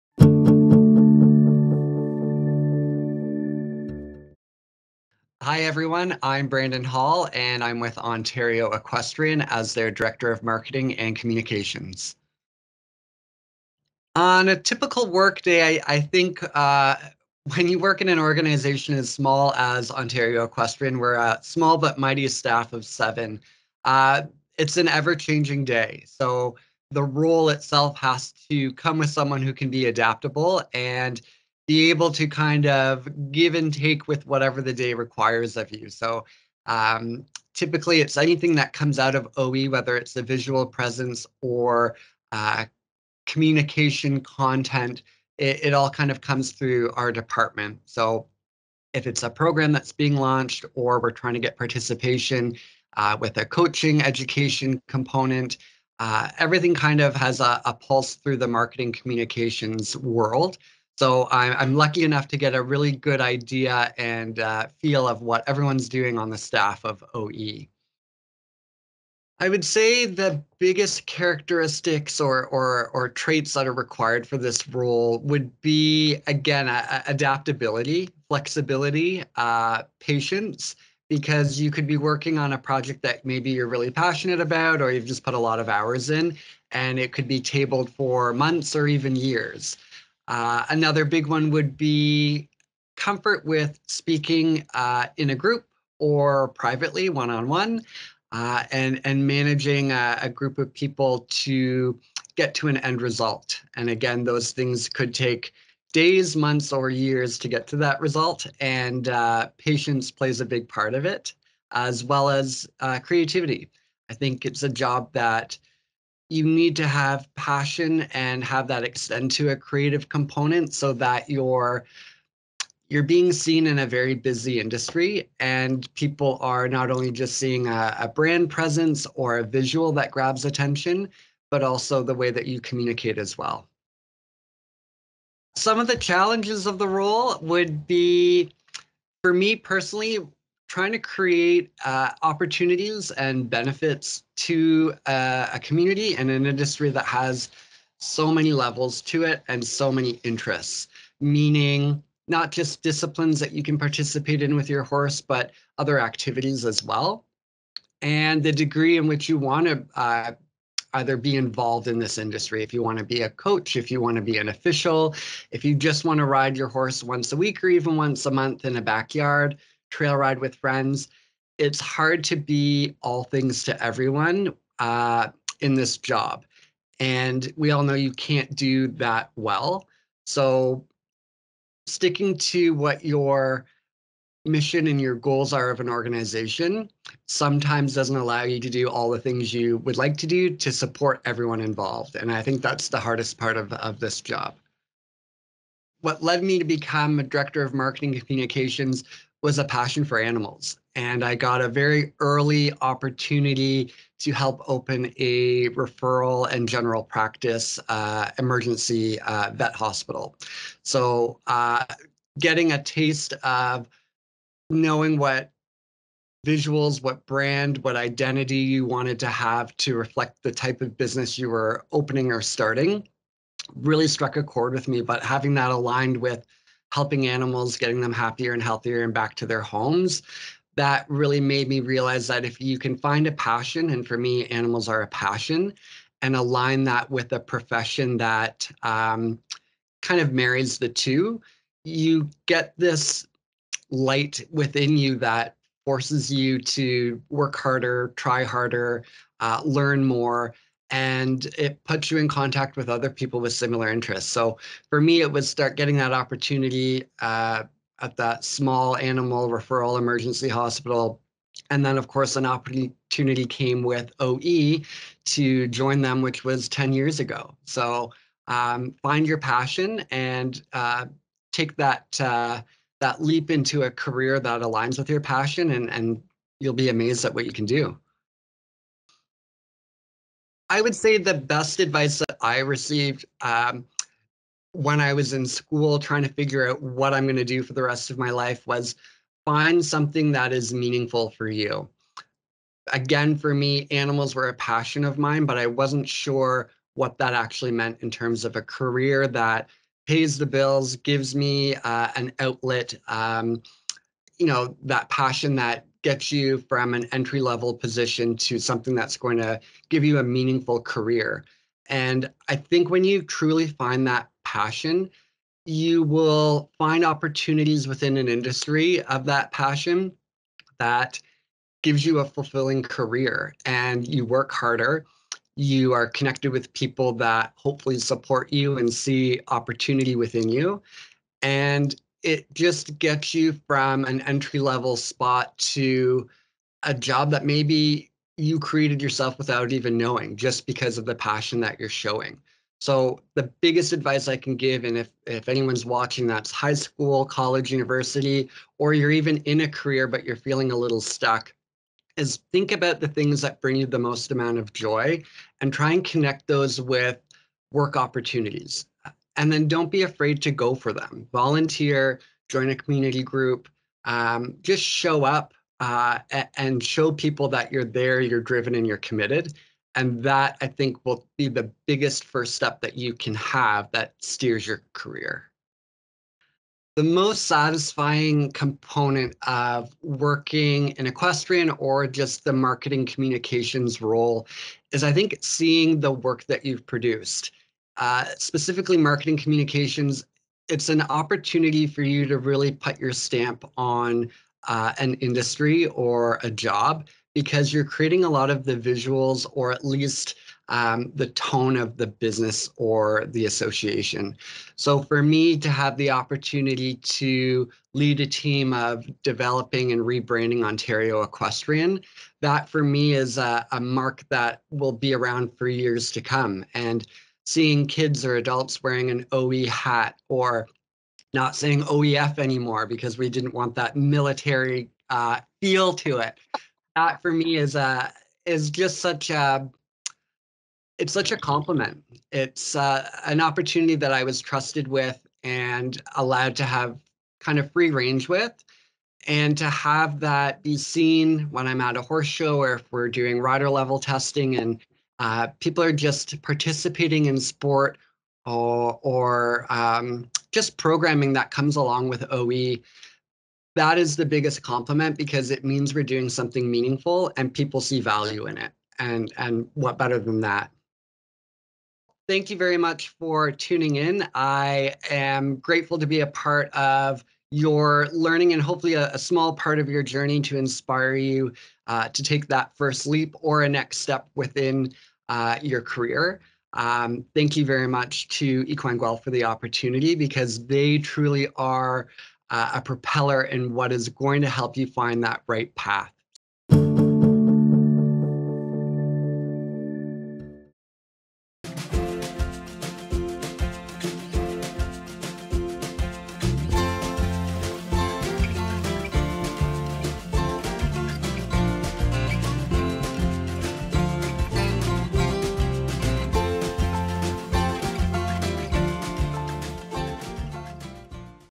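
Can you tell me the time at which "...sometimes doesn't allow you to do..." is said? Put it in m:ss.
3:07.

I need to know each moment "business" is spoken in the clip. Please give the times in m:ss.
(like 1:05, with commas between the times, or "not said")
3:40, 6:42.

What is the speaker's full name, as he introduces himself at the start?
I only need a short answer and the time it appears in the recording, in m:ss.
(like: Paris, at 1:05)
Brandon Hall, at 0:06.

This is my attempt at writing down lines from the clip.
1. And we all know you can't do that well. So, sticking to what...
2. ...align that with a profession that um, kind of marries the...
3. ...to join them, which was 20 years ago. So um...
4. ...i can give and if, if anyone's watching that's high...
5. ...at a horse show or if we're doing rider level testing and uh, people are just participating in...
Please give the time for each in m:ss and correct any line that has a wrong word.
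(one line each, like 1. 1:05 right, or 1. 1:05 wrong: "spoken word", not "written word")
1. 2:56 right
2. 3:56 right
3. 4:25 wrong: "10", not "20"
4. 5:44 right
5. 7:21 right.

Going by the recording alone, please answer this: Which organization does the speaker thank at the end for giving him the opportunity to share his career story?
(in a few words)
Equine Guelph.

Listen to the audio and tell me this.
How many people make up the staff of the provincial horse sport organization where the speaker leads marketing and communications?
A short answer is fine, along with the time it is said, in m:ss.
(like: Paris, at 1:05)
7, at 0:22.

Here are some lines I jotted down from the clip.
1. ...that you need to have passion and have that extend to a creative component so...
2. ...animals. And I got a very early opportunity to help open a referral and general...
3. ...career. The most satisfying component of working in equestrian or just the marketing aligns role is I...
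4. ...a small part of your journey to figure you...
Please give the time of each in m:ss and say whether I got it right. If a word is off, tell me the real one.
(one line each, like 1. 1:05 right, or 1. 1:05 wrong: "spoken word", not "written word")
1. 1:55 right
2. 3:20 right
3. 6:14 wrong: "communications", not "aligns"
4. 7:49 wrong: "inspire", not "figure".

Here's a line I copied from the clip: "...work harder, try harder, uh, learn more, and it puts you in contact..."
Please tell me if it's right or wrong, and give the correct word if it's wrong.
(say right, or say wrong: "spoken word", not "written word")
right.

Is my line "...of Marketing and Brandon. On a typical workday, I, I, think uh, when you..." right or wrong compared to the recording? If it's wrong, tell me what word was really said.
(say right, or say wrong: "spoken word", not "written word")
wrong: "Communications", not "Brandon".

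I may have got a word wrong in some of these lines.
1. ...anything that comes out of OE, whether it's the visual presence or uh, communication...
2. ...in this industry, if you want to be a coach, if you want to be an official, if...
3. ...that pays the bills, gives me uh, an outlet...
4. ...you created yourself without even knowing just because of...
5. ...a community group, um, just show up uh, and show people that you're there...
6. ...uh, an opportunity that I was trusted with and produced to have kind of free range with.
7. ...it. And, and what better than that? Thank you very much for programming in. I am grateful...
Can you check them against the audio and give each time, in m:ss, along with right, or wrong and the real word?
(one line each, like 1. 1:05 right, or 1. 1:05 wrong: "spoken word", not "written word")
1. 0:38 right
2. 2:41 right
3. 4:59 right
4. 5:38 right
5. 6:02 right
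6. 7:12 wrong: "allowed", not "produced"
7. 7:38 wrong: "tuning", not "programming".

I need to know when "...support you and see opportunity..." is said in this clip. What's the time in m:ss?
5:27.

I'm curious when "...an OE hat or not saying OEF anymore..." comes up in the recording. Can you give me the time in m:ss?
6:59.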